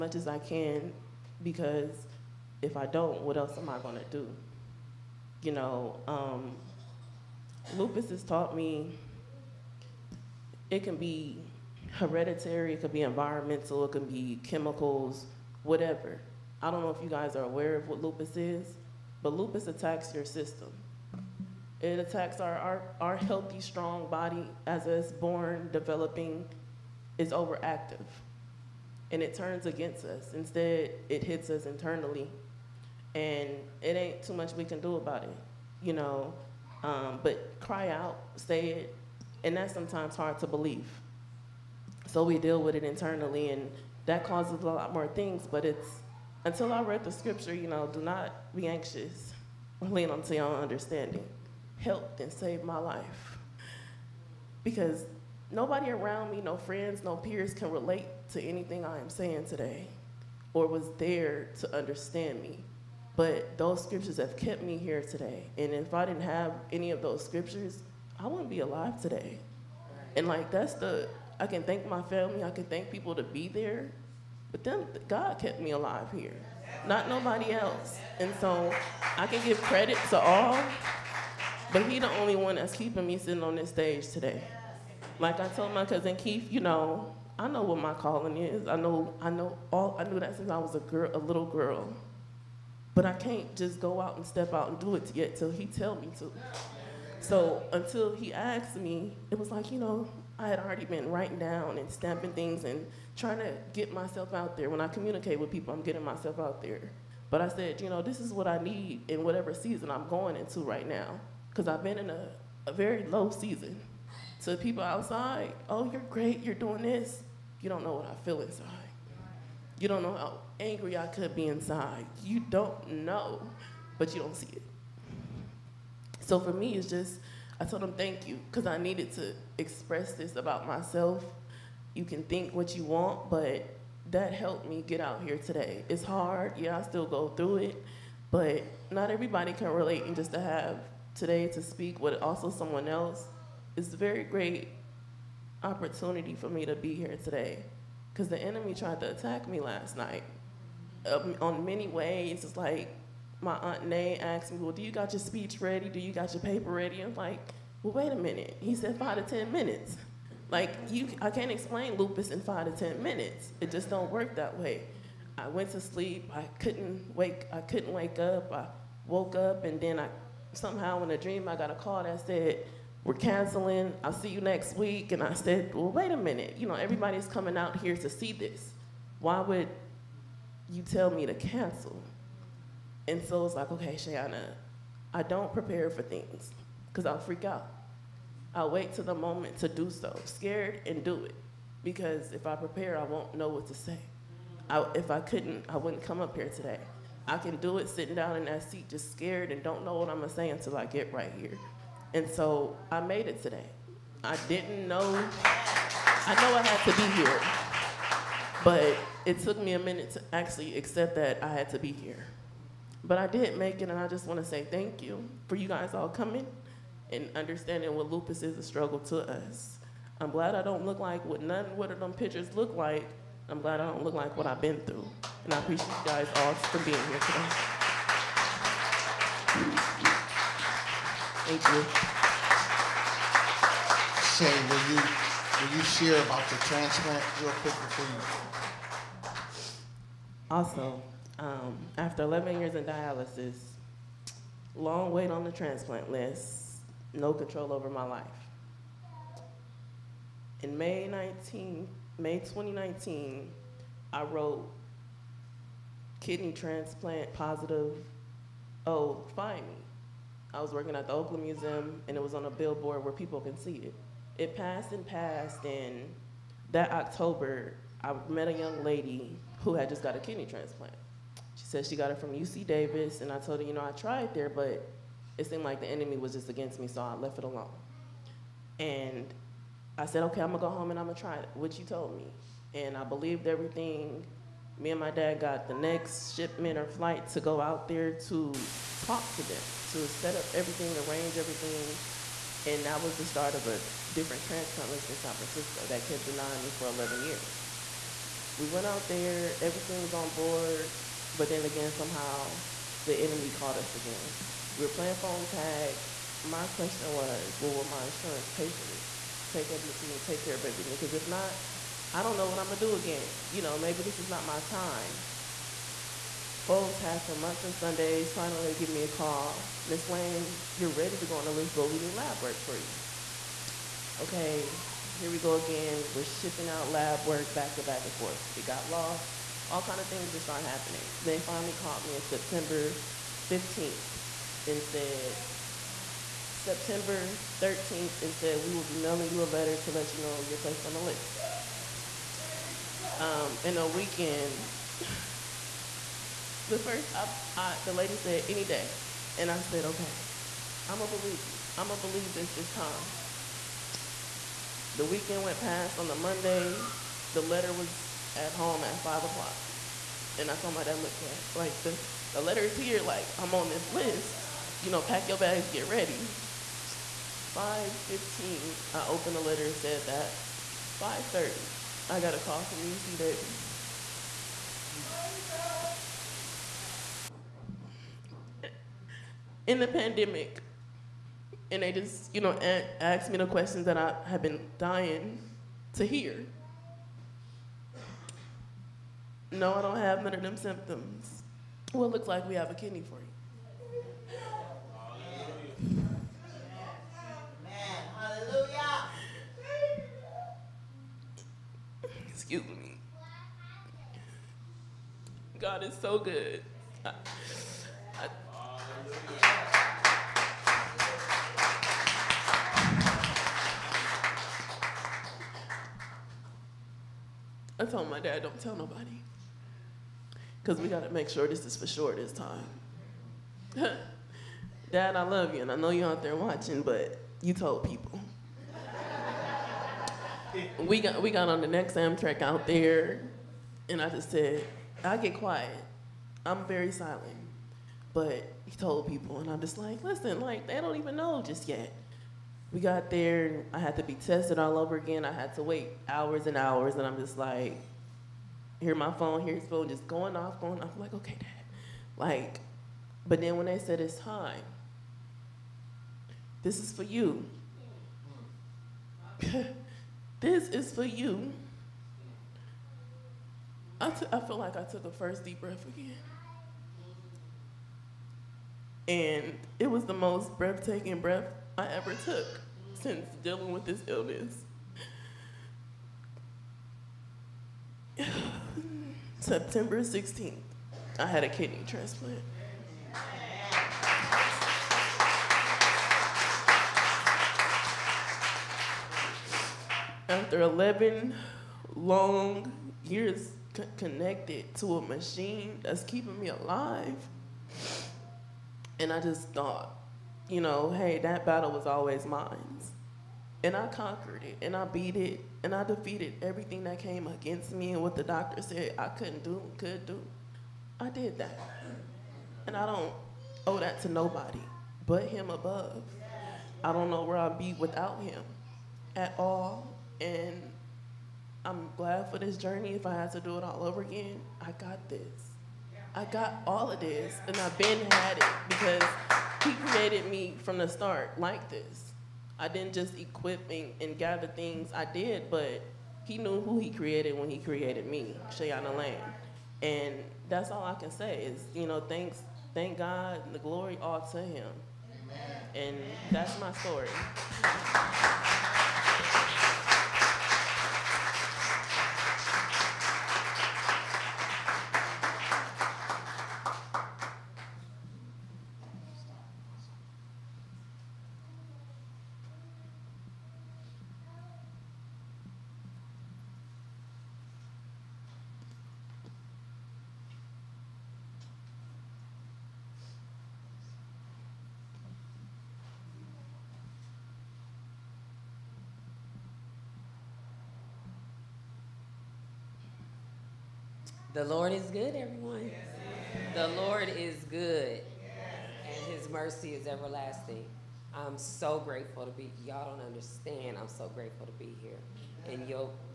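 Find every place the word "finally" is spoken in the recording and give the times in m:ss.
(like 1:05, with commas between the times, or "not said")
5:18, 5:31.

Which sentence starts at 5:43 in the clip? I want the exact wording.
Um, in a weekend, the first, I, I, the lady said, any day.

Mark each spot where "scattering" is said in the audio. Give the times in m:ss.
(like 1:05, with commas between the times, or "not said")
not said.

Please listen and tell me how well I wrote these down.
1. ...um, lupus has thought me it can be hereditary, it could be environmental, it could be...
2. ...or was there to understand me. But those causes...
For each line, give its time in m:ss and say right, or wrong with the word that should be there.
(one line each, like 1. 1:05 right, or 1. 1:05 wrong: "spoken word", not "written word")
1. 0:06 wrong: "taught", not "thought"
2. 1:00 wrong: "scriptures", not "causes".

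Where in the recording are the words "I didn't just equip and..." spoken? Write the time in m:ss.
8:52.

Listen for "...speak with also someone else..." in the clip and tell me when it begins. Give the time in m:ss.
2:21.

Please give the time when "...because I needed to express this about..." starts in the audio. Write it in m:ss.
2:08.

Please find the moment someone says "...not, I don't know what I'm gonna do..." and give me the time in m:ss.
5:11.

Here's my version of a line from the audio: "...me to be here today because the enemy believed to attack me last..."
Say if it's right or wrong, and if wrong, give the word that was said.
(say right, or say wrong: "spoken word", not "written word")
wrong: "tried", not "believed".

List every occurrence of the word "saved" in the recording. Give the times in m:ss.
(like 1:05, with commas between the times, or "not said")
0:52.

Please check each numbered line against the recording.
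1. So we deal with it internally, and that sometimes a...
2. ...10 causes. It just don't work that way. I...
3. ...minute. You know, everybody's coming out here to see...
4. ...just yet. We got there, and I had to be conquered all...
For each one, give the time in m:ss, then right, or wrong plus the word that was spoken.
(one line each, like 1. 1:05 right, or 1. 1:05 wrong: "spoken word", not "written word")
1. 0:42 wrong: "causes", not "sometimes"
2. 2:42 wrong: "minutes", not "causes"
3. 2:56 right
4. 7:21 wrong: "tested", not "conquered".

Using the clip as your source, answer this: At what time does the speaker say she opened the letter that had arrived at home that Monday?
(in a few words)
5:15.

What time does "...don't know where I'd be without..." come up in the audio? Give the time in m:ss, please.
8:36.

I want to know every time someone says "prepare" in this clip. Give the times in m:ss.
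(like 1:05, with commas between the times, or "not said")
3:05, 3:12.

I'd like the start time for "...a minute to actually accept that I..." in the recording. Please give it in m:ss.
3:29.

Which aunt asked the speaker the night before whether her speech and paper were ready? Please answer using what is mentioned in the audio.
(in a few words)
Nay.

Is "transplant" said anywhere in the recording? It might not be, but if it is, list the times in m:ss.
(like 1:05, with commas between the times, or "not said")
3:56, 4:05, 4:16, 4:30, 4:54, 8:01.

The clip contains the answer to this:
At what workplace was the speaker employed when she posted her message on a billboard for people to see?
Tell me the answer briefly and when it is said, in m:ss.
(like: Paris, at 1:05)
Oakland Museum, at 4:21.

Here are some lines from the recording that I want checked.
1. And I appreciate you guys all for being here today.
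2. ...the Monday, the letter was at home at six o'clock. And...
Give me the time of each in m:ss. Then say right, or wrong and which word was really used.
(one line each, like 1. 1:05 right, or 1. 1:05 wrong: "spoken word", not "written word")
1. 3:45 right
2. 5:56 wrong: "five", not "six".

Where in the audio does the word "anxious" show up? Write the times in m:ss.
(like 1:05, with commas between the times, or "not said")
0:48.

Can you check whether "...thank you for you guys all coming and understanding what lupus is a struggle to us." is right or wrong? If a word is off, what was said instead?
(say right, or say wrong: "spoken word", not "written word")
right.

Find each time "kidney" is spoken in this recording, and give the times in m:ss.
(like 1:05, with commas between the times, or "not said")
4:16, 4:30, 6:32, 8:01.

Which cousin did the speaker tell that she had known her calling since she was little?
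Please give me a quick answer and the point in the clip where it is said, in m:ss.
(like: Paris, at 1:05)
Keith, at 1:26.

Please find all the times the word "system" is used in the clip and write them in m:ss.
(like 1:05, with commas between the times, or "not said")
0:20.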